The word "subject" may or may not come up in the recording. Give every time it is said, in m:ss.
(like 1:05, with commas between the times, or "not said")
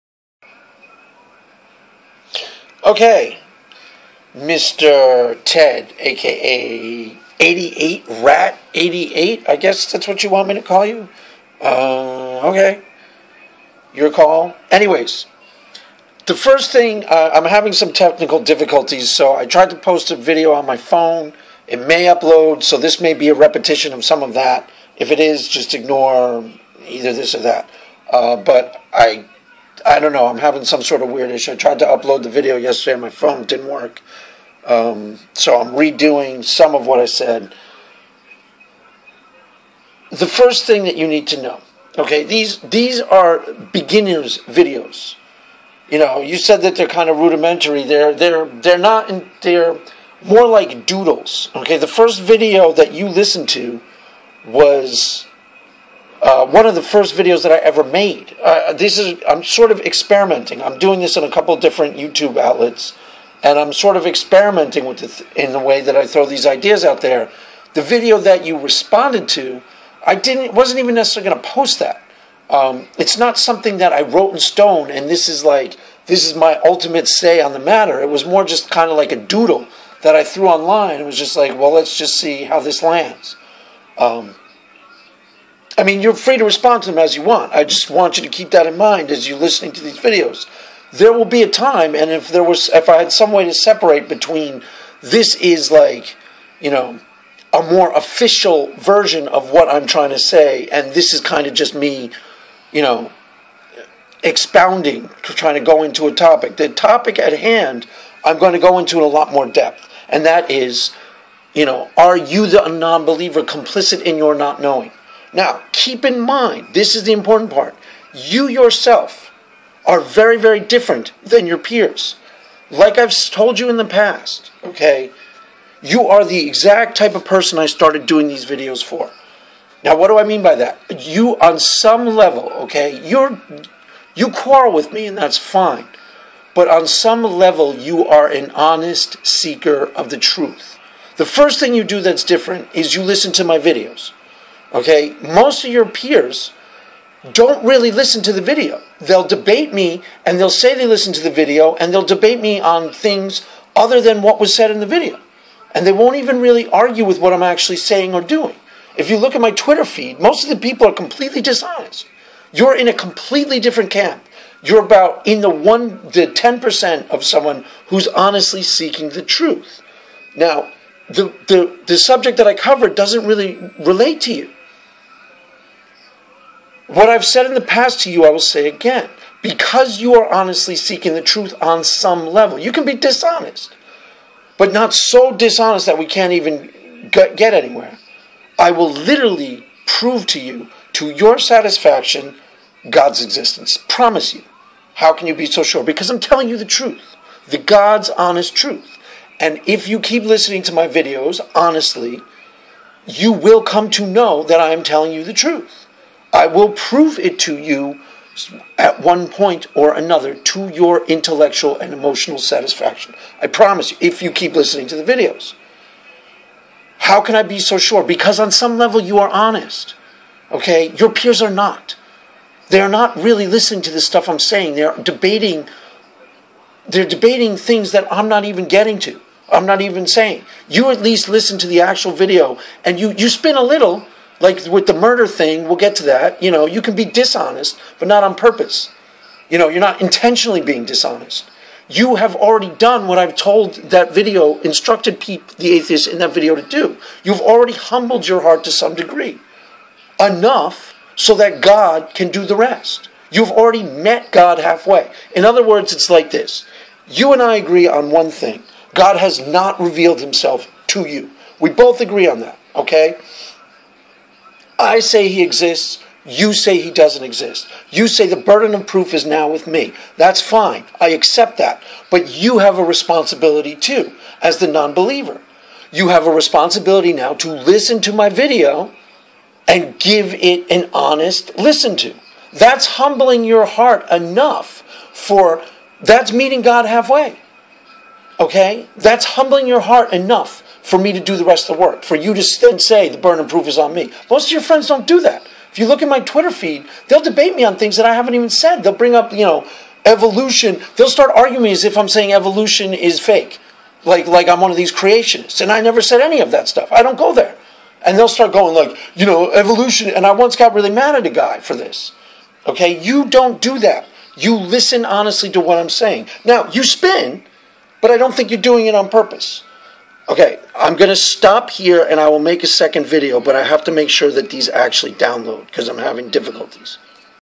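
2:51.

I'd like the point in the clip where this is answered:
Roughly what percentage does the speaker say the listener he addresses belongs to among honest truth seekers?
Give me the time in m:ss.
2:46.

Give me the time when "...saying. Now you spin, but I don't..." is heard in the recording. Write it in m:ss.
5:15.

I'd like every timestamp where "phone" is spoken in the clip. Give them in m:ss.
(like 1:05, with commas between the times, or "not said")
0:20, 0:33.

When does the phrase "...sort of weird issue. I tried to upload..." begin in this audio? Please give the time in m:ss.
0:30.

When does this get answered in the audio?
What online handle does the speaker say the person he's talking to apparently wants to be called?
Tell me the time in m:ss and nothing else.
0:07.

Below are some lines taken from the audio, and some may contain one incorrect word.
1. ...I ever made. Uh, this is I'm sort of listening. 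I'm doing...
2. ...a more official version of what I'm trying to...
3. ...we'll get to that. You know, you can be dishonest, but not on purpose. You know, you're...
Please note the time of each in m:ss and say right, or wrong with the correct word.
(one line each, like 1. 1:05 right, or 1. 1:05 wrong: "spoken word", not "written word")
1. 0:57 wrong: "experimenting", not "listening"
2. 1:37 right
3. 3:55 right.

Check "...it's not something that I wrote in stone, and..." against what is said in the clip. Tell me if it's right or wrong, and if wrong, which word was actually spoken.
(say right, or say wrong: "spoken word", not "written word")
right.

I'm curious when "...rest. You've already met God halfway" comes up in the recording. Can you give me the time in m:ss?
4:12.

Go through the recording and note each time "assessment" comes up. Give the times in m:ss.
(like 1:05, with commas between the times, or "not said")
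not said.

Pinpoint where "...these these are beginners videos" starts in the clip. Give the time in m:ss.
0:42.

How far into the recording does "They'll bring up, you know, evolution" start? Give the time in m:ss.
4:58.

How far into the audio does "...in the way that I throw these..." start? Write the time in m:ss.
1:05.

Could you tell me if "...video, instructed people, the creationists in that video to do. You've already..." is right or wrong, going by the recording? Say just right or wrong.
wrong.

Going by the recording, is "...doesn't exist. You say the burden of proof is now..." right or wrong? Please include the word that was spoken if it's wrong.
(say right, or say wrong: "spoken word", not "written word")
right.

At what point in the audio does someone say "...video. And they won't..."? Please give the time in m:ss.
2:34.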